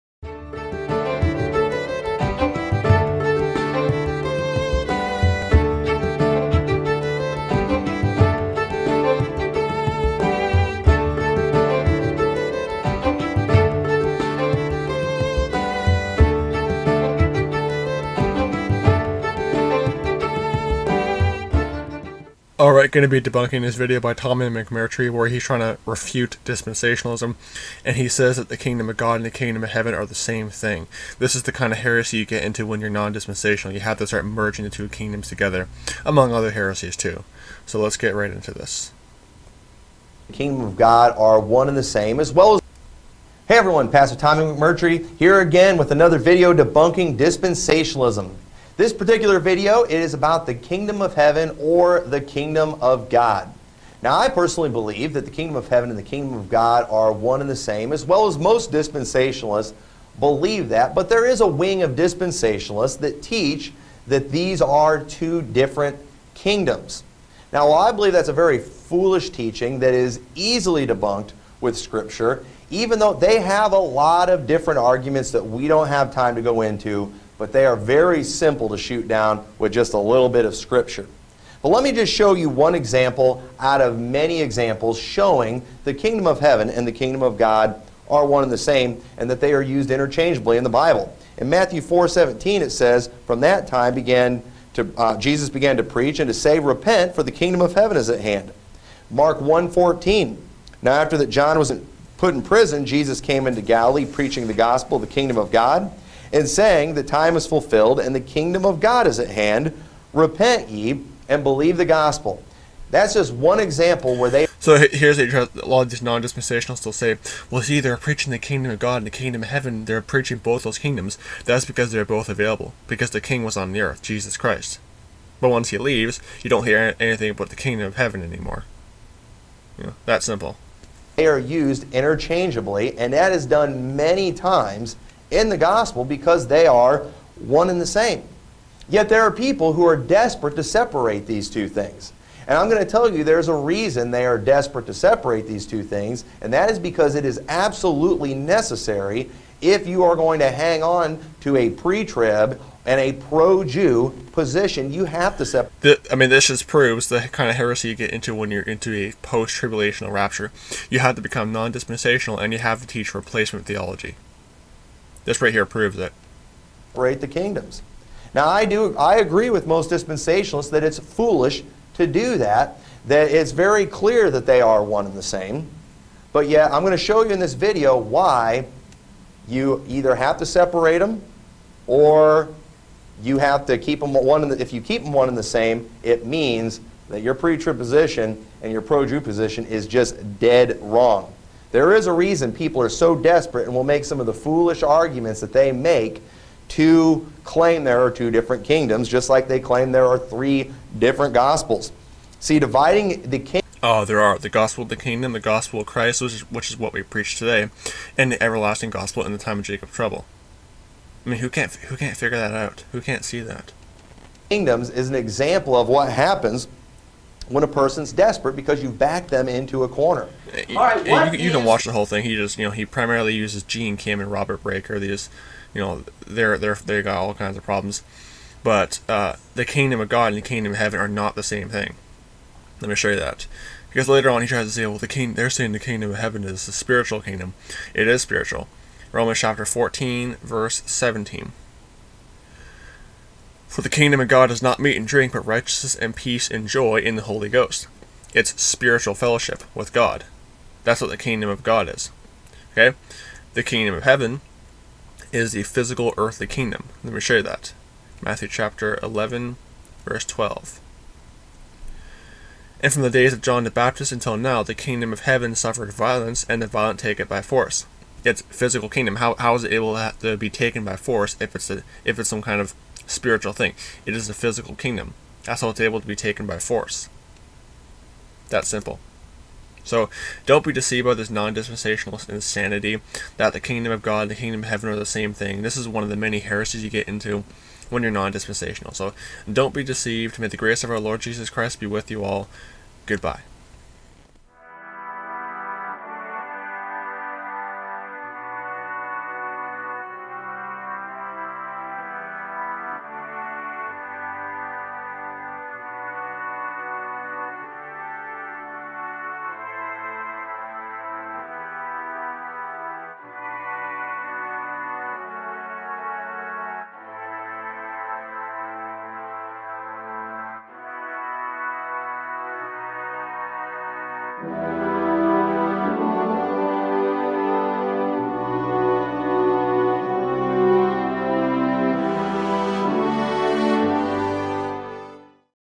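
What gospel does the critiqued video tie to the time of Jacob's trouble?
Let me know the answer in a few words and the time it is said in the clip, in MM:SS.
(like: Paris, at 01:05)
the everlasting gospel, at 03:28.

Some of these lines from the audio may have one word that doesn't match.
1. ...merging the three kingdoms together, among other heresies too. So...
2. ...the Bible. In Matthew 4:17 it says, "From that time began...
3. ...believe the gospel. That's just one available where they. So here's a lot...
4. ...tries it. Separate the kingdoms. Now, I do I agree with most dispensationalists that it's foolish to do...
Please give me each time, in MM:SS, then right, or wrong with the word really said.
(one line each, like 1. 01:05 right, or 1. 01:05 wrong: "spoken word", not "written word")
1. 00:34 wrong: "two", not "three"
2. 01:30 right
3. 01:51 wrong: "example", not "available"
4. 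02:45 wrong: "proves", not "tries".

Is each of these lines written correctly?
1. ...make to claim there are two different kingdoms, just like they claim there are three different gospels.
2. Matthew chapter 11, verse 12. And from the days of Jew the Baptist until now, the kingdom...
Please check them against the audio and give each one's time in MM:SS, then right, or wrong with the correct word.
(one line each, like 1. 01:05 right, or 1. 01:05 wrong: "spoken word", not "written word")
1. 03:15 right
2. 04:18 wrong: "John", not "Jew".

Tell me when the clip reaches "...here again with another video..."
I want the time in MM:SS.
00:45.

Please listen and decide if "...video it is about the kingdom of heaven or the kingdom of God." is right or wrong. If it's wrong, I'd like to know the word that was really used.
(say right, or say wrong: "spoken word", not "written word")
right.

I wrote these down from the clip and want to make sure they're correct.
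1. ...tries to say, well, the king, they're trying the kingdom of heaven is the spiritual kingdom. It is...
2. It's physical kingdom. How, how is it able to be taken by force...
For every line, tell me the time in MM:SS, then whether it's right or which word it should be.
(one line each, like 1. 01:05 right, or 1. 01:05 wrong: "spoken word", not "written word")
1. 03:54 wrong: "saying", not "trying"
2. 04:28 right.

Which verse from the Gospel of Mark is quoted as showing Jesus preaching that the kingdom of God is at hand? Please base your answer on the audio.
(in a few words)
Mark 1:14.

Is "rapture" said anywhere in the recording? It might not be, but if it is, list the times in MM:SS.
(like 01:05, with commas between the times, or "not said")
02:40.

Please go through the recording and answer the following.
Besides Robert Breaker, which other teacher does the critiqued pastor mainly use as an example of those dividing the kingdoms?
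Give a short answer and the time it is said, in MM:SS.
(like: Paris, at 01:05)
Gene Kim, at 03:43.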